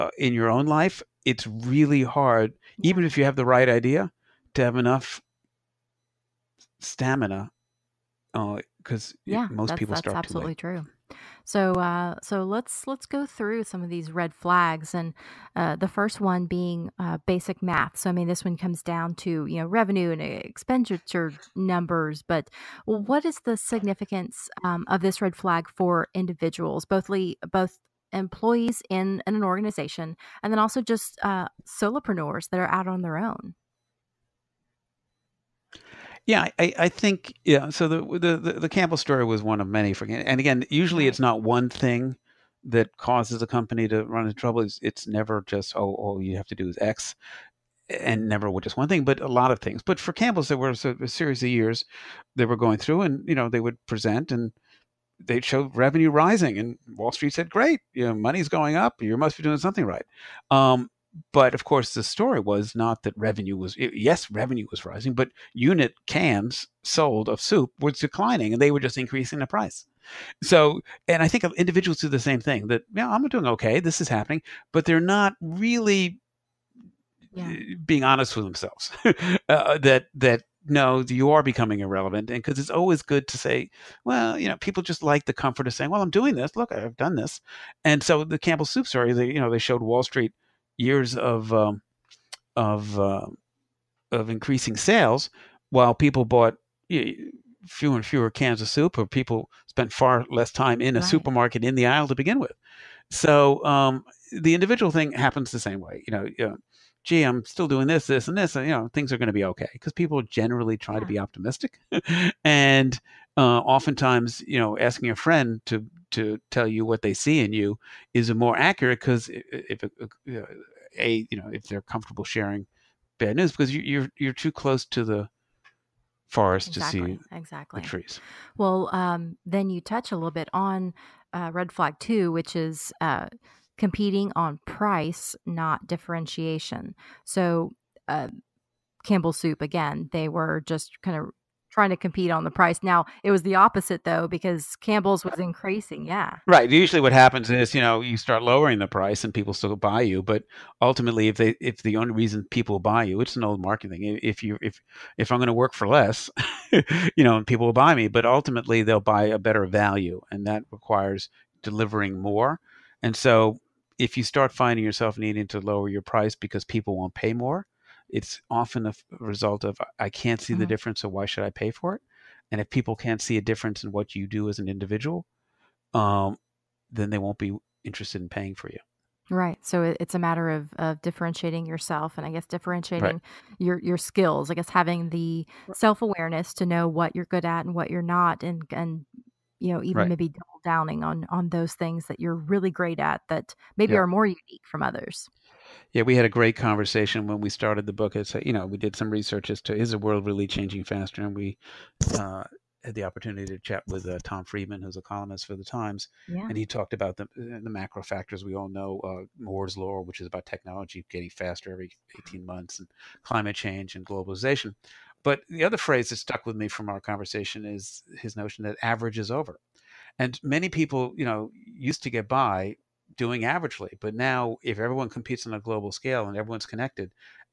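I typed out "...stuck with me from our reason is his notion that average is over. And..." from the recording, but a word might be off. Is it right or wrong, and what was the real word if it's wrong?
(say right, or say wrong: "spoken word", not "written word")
wrong: "conversation", not "reason".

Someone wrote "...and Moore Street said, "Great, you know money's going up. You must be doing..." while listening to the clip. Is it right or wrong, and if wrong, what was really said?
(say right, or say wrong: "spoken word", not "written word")
wrong: "Wall", not "Moore".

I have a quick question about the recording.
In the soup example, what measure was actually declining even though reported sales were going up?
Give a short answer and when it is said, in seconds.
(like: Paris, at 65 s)
Unit cans sold, at 65 s.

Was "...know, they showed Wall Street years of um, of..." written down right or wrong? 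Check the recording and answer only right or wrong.
right.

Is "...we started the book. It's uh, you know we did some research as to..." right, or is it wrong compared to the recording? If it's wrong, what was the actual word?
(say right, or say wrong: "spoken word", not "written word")
right.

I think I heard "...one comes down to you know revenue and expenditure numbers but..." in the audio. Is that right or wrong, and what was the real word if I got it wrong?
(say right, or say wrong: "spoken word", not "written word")
right.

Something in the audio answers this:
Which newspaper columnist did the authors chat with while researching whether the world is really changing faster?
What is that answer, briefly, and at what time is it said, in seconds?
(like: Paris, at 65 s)
Tom Friedman, at 204 s.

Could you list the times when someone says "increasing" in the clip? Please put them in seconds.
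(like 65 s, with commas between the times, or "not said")
68 s, 94 s, 145 s.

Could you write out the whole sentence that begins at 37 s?
So the, the the Campbell story was one of many.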